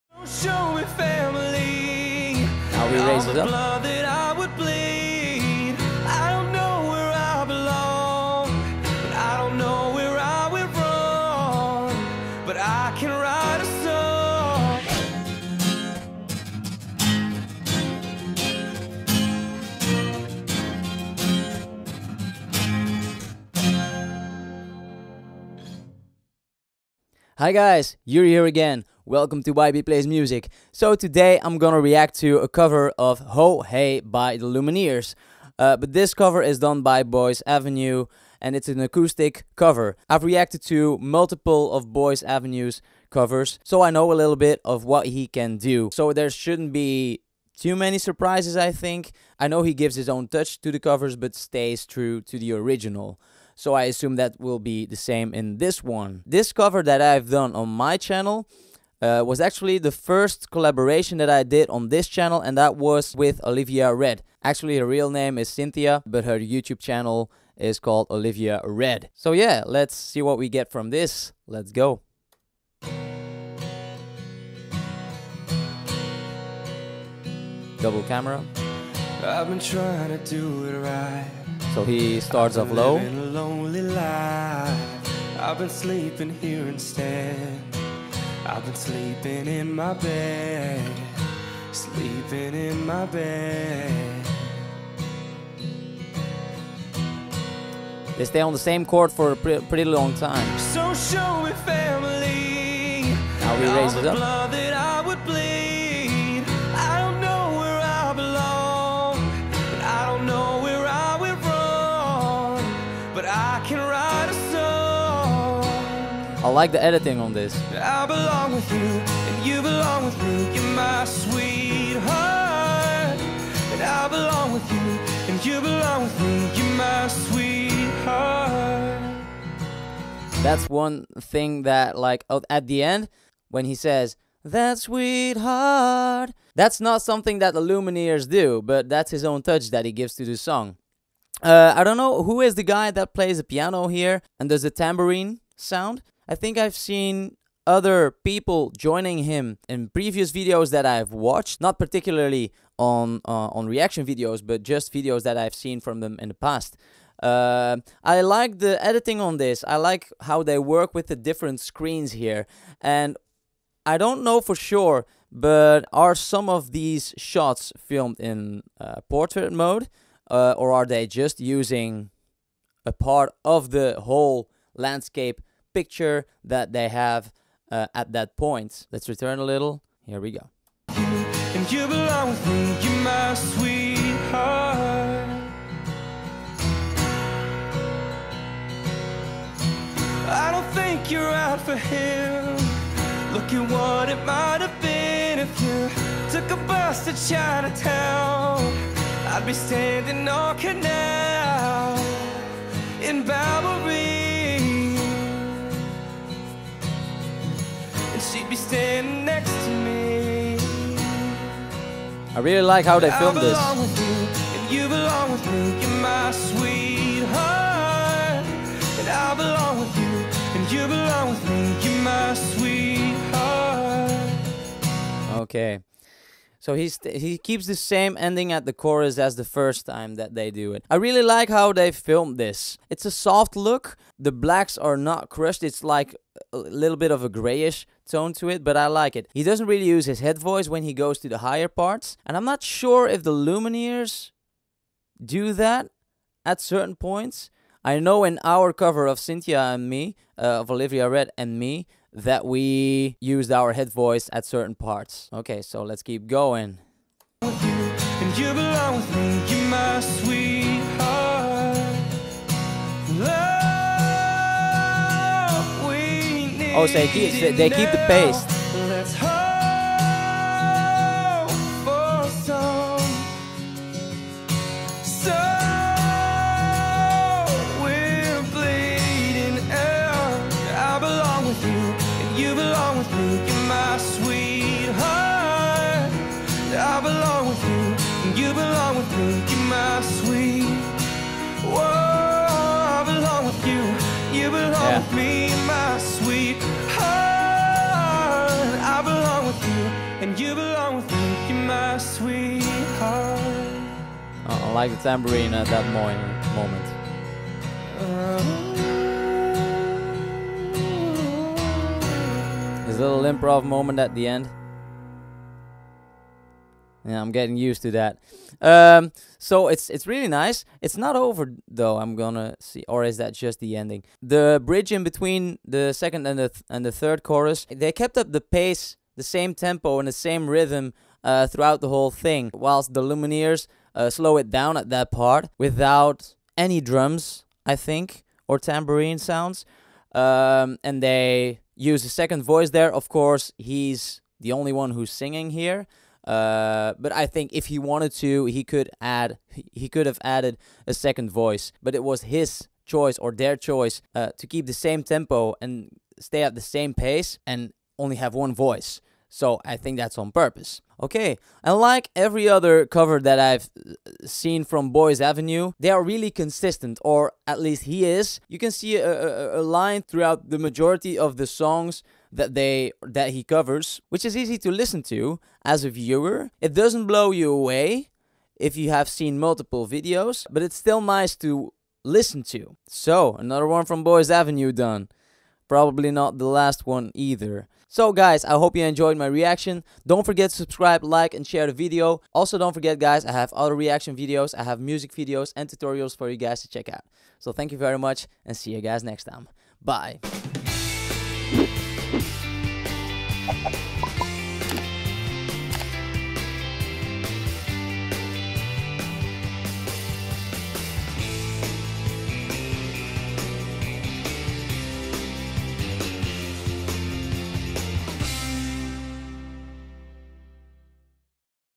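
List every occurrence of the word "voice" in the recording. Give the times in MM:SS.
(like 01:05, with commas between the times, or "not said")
04:00, 04:13, 05:42, 05:51, 05:58.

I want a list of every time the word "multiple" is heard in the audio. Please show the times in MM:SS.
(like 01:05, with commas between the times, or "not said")
00:40, 06:19.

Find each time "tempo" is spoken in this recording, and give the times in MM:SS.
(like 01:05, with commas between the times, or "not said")
05:29, 05:55.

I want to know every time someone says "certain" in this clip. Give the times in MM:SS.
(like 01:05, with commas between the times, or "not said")
04:06, 04:14.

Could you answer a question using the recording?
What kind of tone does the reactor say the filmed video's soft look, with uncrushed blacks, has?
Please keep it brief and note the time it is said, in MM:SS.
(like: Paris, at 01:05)
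Grayish tone, at 03:57.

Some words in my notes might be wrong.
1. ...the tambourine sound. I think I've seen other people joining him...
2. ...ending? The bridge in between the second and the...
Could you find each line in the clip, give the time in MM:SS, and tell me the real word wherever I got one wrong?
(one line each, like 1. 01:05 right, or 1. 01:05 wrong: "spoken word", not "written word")
1. 02:24 right
2. 05:23 right.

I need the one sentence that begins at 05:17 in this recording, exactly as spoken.
Yeah, I'm getting used to that.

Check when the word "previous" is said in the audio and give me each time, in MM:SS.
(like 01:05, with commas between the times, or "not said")
02:29.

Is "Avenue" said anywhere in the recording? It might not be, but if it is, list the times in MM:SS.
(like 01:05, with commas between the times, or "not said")
00:37, 00:42, 06:05, 06:24.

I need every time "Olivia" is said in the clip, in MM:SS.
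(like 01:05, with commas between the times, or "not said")
01:03, 01:08, 04:10.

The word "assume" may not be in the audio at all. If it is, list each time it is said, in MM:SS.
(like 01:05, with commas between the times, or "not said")
00:53.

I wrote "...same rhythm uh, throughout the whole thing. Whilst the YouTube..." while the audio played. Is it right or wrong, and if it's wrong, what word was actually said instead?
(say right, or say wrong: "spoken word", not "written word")
wrong: "Lumineers", not "YouTube".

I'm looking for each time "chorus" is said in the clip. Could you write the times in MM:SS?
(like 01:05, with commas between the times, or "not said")
03:48, 05:27.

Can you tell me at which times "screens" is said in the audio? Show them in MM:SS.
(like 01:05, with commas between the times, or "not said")
02:41.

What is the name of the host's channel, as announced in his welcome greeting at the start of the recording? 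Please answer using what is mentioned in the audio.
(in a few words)
YB Plays Music.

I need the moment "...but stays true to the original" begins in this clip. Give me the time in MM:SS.
00:51.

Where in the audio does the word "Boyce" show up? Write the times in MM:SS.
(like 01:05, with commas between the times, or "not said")
00:37, 00:41, 06:04, 06:24.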